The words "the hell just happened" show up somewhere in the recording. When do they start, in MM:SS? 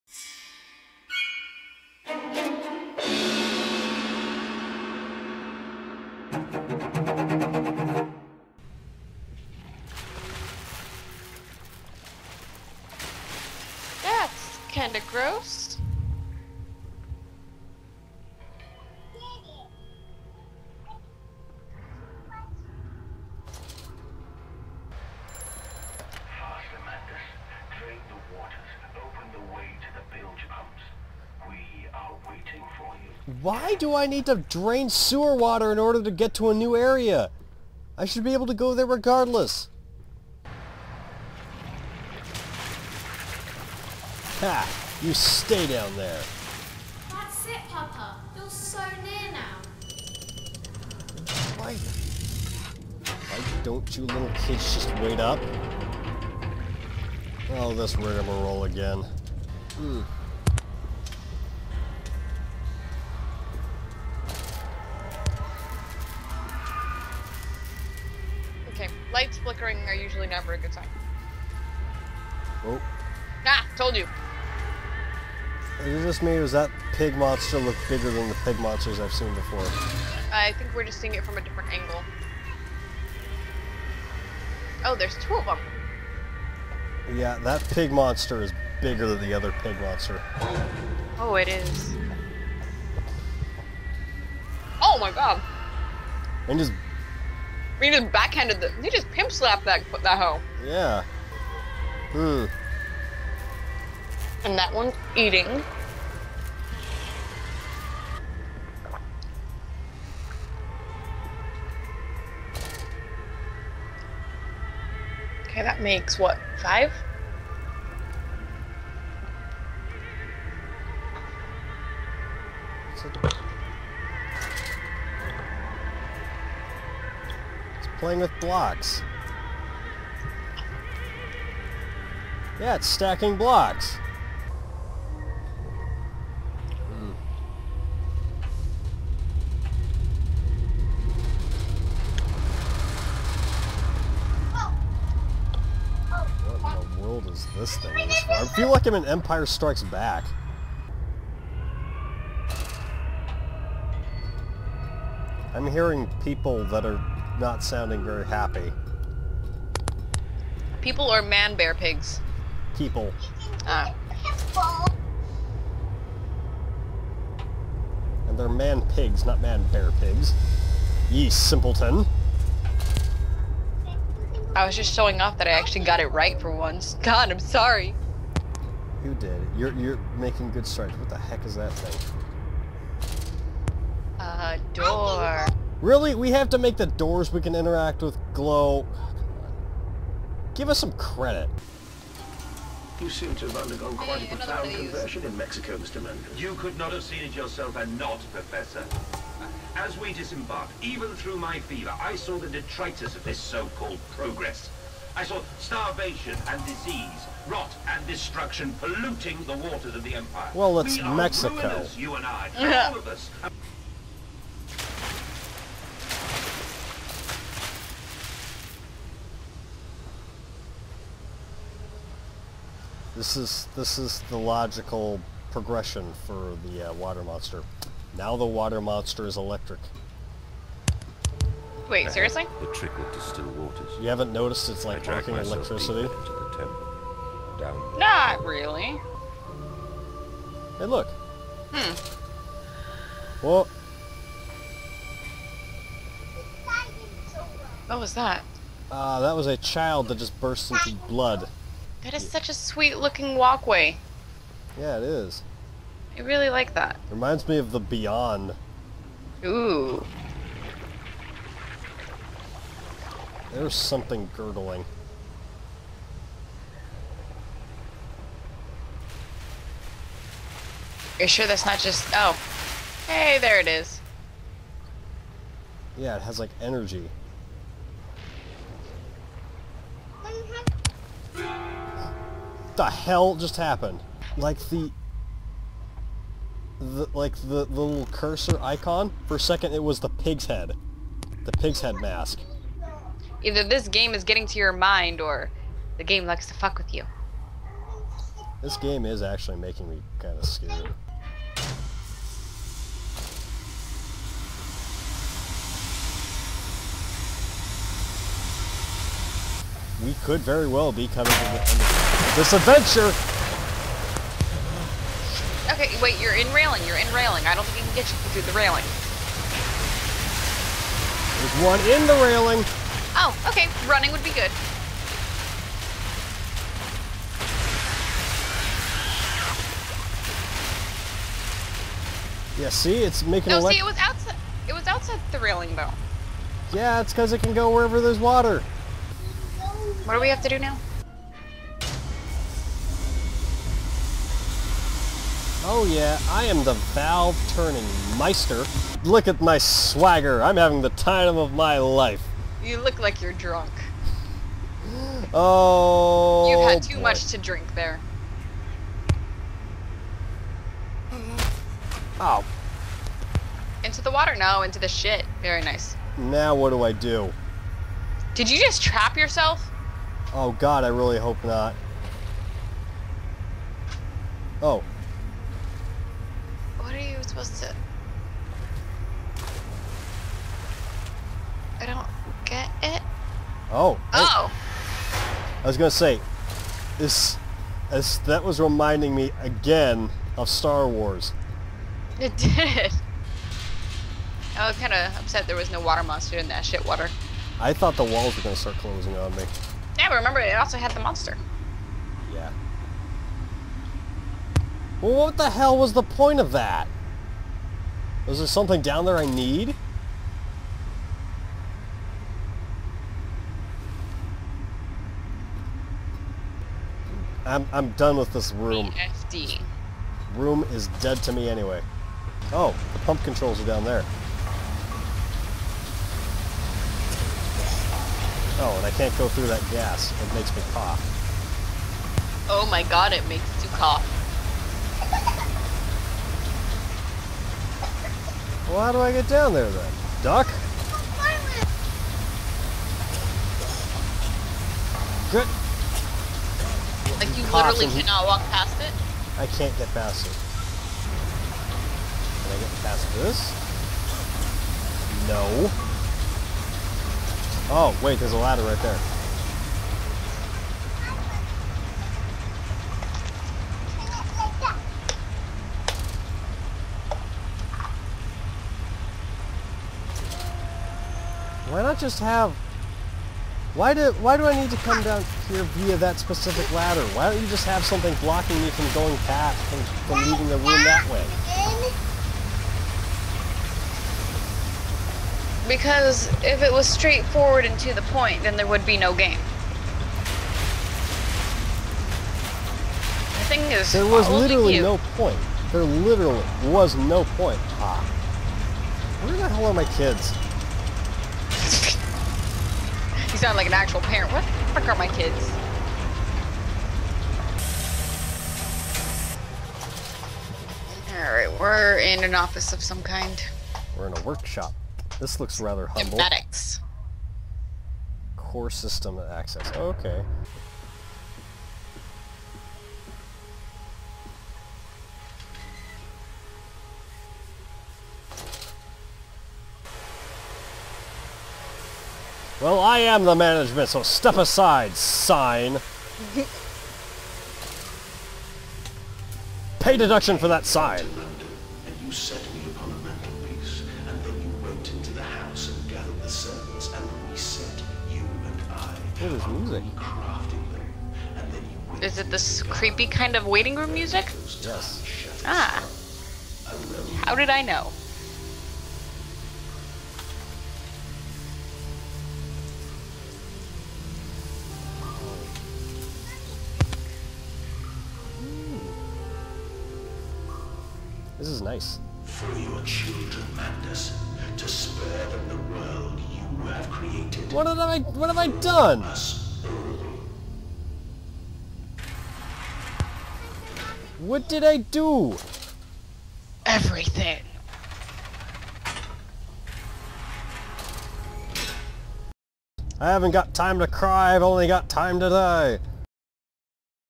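04:42.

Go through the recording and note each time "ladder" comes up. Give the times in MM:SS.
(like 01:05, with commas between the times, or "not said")
07:38, 07:56.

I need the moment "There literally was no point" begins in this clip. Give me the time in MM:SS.
08:15.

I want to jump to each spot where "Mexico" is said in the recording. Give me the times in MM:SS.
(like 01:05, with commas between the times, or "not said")
03:15, 03:31.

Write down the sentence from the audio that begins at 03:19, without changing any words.
As we disembarked, even through my fever, I saw the detritus of this so-called progress.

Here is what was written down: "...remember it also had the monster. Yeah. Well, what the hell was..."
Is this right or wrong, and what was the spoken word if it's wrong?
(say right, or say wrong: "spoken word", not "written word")
right.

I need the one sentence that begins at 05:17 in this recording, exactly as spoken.
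I don't think you can get you through the railing.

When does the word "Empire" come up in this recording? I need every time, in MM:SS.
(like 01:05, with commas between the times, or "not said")
02:29, 03:30.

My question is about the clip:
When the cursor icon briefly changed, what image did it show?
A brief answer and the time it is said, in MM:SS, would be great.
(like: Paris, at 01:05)
Pig's head mask, at 04:51.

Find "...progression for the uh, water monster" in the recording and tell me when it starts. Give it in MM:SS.
03:45.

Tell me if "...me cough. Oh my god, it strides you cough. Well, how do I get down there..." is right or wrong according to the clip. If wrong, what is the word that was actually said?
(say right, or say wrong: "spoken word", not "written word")
wrong: "makes", not "strides".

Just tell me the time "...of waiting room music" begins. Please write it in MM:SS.
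09:13.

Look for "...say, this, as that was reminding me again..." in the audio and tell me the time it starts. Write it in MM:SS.
06:25.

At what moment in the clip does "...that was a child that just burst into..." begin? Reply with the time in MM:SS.
04:09.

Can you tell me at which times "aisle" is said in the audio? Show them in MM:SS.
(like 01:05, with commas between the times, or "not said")
not said.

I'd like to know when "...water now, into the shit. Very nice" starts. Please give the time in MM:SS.
06:04.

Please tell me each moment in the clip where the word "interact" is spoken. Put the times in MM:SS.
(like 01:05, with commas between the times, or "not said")
03:07.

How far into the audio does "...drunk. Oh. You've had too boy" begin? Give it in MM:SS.
05:53.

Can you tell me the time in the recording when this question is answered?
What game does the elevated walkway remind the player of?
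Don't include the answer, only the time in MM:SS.
04:17.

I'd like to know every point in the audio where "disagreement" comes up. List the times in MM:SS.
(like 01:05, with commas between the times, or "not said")
not said.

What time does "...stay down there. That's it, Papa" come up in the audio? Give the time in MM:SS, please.
00:45.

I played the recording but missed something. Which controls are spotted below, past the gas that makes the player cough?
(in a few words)
Pump controls.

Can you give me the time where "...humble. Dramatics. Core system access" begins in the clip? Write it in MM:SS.
08:35.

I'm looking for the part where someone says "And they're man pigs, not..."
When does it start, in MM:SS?
02:48.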